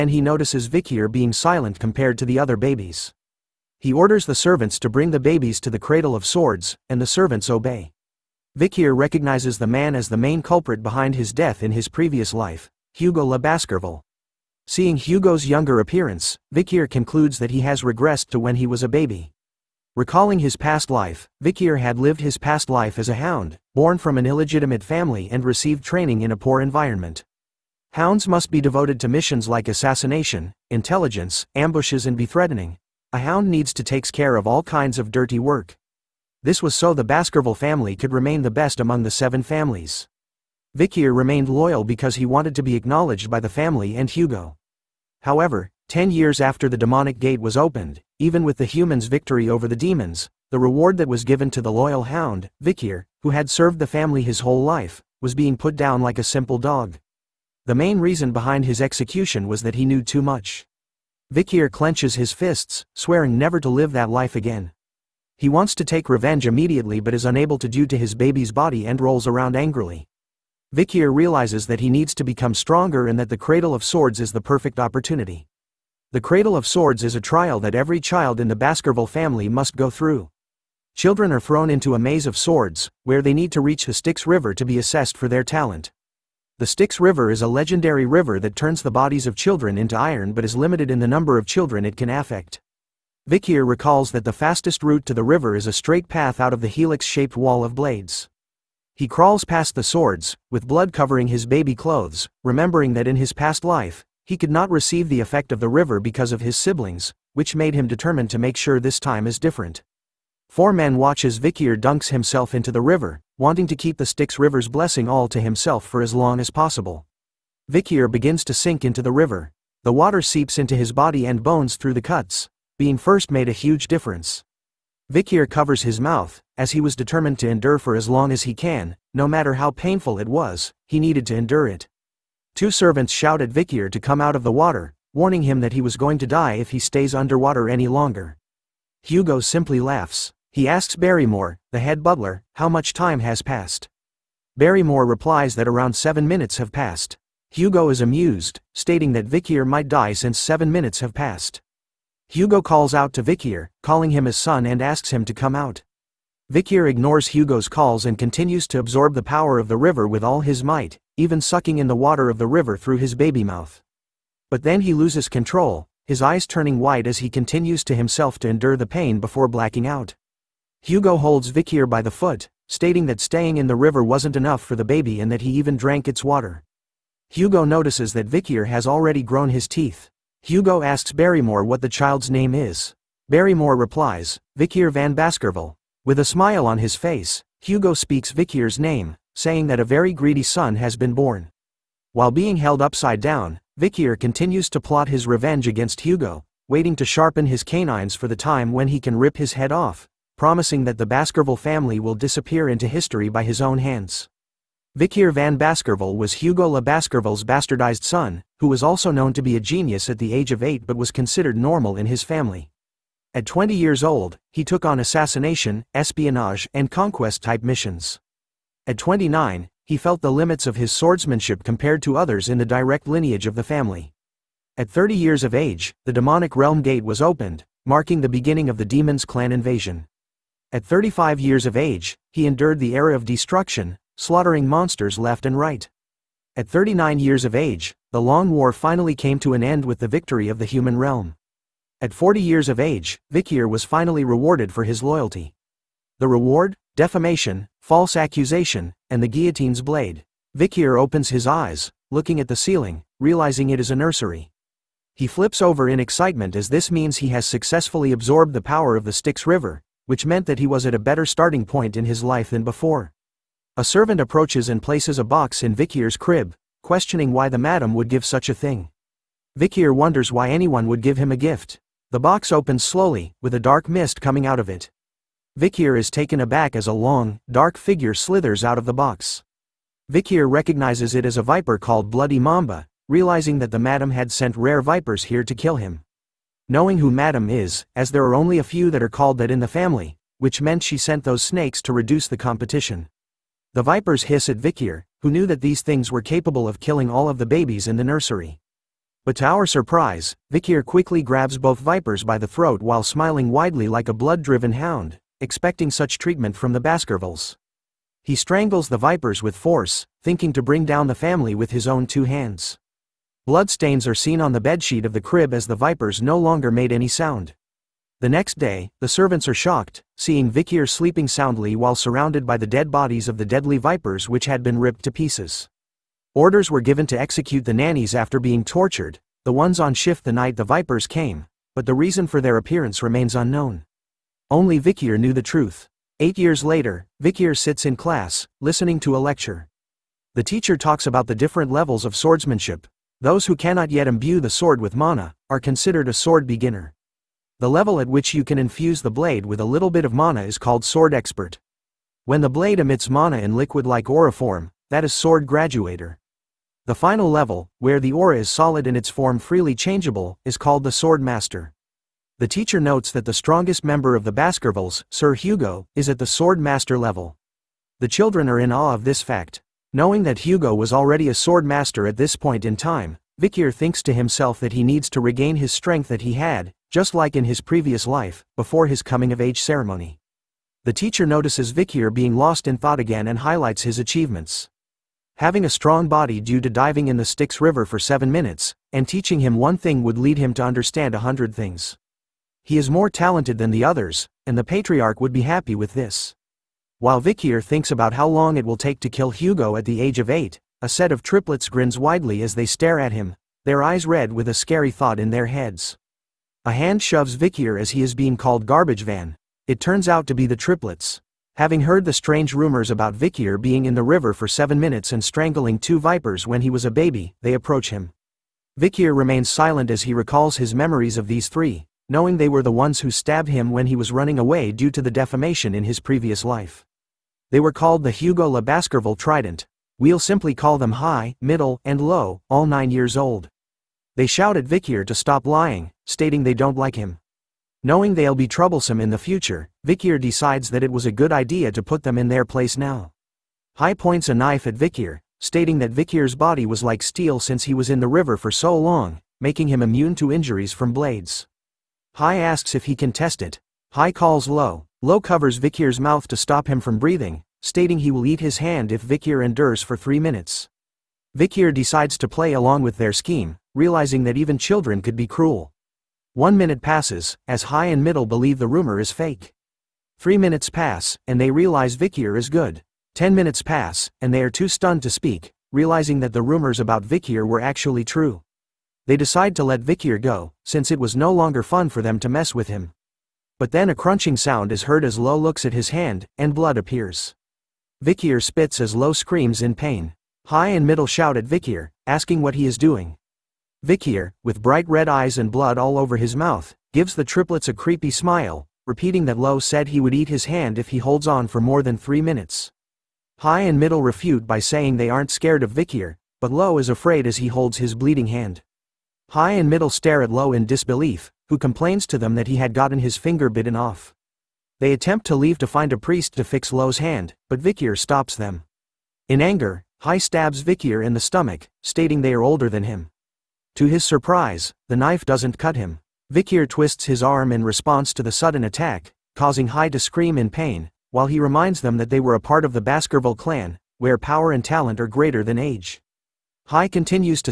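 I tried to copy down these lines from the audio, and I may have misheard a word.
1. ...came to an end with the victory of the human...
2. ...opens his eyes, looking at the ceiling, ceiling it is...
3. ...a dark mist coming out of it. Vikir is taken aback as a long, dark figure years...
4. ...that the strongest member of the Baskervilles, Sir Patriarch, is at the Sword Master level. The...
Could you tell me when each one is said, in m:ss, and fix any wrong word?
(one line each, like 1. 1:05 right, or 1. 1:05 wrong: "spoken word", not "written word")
1. 3:59 right
2. 4:10 wrong: "realizing", not "ceiling"
3. 4:33 wrong: "slithers", not "years"
4. 6:03 wrong: "Hugo", not "Patriarch".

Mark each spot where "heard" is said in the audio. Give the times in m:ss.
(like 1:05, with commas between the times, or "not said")
6:51, 8:04.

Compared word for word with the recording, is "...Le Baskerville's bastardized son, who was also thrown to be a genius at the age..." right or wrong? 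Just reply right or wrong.
wrong.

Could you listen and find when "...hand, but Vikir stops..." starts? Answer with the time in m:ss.
8:36.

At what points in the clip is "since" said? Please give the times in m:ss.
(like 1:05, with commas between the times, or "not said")
2:30, 7:27, 8:00.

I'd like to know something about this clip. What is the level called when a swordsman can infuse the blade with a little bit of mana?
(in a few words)
Sword Expert.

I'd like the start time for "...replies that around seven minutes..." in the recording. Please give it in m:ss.
2:25.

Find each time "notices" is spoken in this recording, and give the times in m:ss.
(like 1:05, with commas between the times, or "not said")
0:00, 2:57, 6:21.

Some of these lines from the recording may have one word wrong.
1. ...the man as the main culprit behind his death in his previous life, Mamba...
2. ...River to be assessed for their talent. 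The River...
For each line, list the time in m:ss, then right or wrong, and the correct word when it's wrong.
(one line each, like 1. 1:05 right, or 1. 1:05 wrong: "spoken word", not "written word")
1. 0:09 wrong: "Hugo", not "Mamba"
2. 1:24 wrong: "Styx", not "River".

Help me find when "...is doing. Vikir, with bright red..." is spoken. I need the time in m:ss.
8:12.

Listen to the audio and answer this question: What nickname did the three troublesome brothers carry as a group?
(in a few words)
Hugo La Baskerville Trident.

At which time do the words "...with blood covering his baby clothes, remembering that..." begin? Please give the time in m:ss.
1:40.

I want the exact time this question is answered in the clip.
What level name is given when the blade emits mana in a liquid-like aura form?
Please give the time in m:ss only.
5:55.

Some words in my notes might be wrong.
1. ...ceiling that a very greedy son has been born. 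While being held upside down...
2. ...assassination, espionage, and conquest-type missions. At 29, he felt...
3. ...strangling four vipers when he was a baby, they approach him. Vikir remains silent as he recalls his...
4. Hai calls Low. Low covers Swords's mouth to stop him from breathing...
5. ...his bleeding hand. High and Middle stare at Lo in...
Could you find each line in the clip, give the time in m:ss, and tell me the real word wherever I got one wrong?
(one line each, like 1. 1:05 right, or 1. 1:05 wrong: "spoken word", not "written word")
1. 3:09 wrong: "saying", not "ceiling"
2. 3:35 right
3. 6:55 wrong: "two", not "four"
4. 7:33 wrong: "Vikir", not "Swords"
5. 8:27 right.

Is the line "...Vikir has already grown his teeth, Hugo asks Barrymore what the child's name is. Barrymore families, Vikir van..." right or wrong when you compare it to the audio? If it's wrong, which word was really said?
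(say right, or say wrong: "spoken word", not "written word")
wrong: "replies", not "families".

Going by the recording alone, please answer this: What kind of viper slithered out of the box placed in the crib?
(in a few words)
Bloody Mamba.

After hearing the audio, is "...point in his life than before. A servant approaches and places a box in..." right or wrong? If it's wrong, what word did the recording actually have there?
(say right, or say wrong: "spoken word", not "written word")
right.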